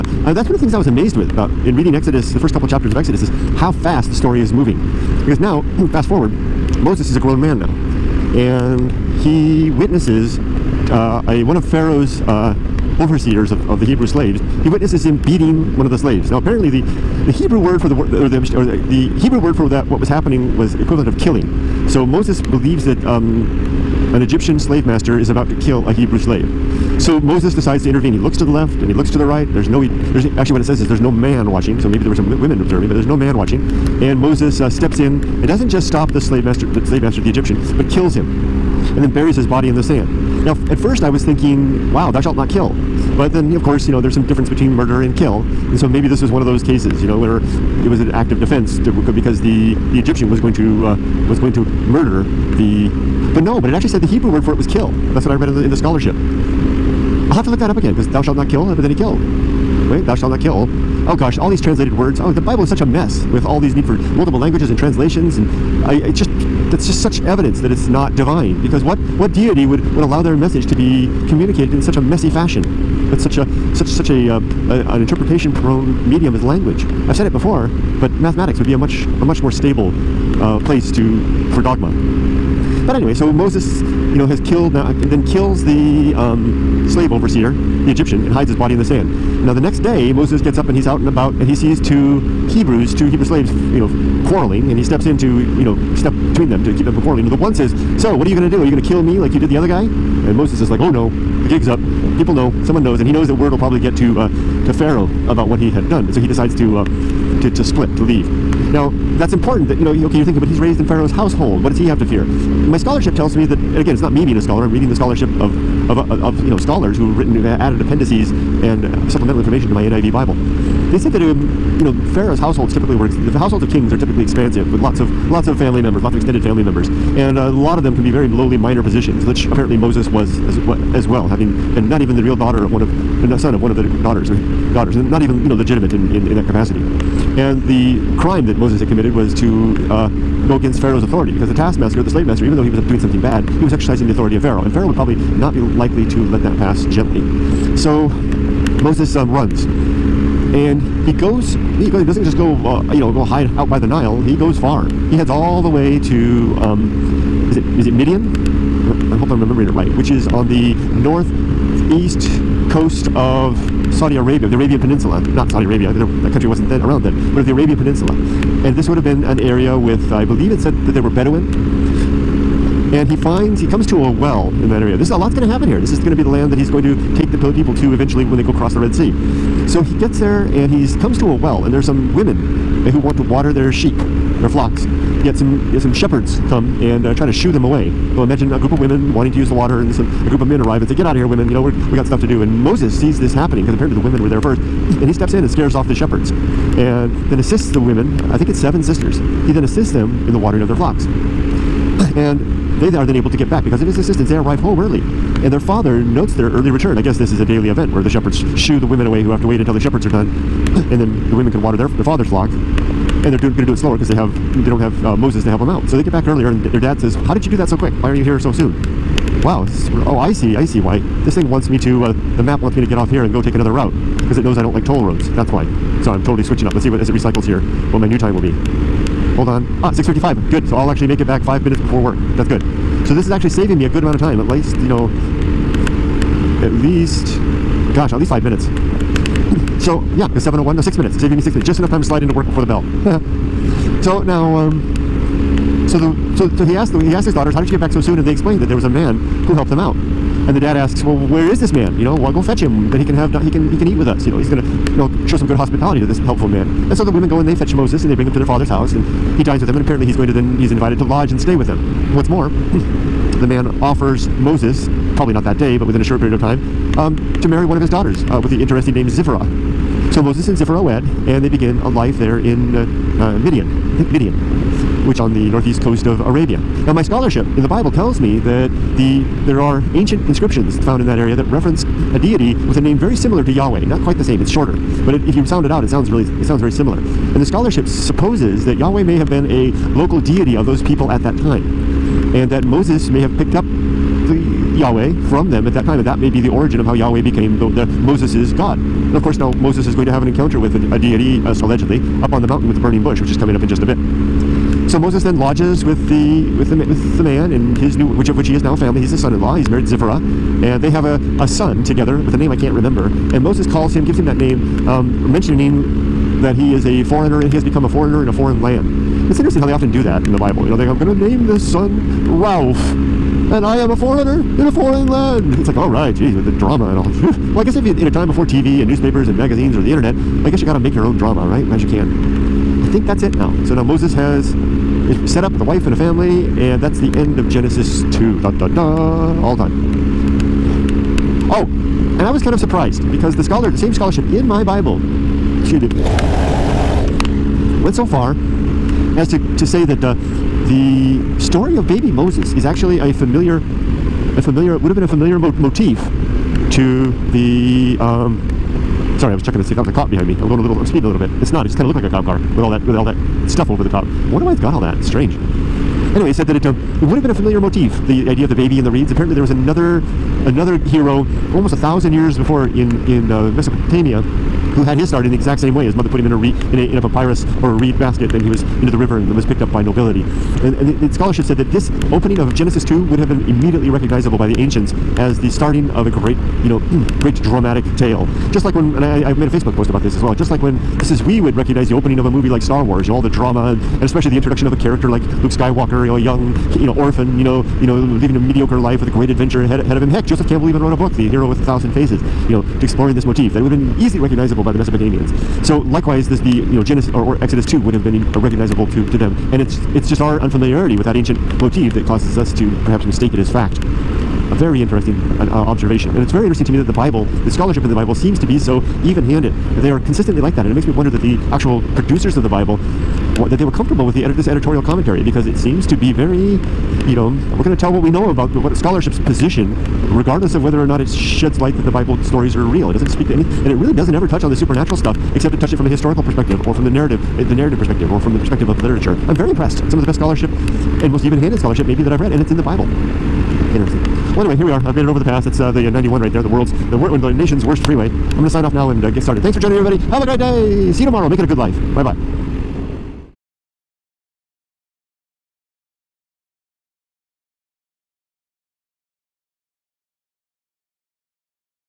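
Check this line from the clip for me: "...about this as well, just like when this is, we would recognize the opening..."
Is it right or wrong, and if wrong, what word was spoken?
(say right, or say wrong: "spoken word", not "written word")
right.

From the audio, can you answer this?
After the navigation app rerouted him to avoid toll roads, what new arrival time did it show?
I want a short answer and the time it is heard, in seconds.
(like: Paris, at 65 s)
6:55, at 229 s.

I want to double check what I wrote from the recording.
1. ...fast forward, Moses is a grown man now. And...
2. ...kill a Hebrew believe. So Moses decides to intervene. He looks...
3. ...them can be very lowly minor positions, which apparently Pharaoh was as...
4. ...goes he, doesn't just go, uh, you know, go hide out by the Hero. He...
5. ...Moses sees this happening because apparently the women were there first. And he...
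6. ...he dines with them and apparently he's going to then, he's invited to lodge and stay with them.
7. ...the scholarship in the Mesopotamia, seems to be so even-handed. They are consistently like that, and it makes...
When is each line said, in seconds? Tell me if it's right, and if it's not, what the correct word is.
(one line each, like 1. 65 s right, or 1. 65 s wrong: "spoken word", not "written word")
1. 5 s right
2. 25 s wrong: "slave", not "believe"
3. 127 s wrong: "Moses", not "Pharaoh"
4. 151 s wrong: "Nile", not "Hero"
5. 192 s right
6. 259 s right
7. 417 s wrong: "Bible", not "Mesopotamia".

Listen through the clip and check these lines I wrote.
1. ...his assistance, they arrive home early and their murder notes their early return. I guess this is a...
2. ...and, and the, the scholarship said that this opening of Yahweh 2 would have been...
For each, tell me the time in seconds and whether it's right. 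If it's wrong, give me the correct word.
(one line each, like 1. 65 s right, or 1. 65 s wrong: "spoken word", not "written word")
1. 203 s wrong: "father", not "murder"
2. 380 s wrong: "Genesis", not "Yahweh".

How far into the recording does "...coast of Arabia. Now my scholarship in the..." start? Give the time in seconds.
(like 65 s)
275 s.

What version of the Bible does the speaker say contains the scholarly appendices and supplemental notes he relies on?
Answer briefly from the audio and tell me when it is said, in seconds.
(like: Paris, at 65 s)
NIV, at 119 s.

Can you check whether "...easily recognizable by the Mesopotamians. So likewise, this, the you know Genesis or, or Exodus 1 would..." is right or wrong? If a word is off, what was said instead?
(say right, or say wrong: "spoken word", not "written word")
wrong: "2", not "1".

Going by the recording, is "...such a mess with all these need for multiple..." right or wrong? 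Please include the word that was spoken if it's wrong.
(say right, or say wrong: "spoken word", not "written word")
right.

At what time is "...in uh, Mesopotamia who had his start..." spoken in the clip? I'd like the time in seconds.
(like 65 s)
373 s.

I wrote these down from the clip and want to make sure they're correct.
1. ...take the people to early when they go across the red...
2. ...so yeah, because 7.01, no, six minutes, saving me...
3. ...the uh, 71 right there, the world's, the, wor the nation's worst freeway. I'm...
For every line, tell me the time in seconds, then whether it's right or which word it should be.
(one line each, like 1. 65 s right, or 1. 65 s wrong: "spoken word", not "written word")
1. 177 s wrong: "eventually", not "early"
2. 239 s right
3. 445 s wrong: "91", not "71".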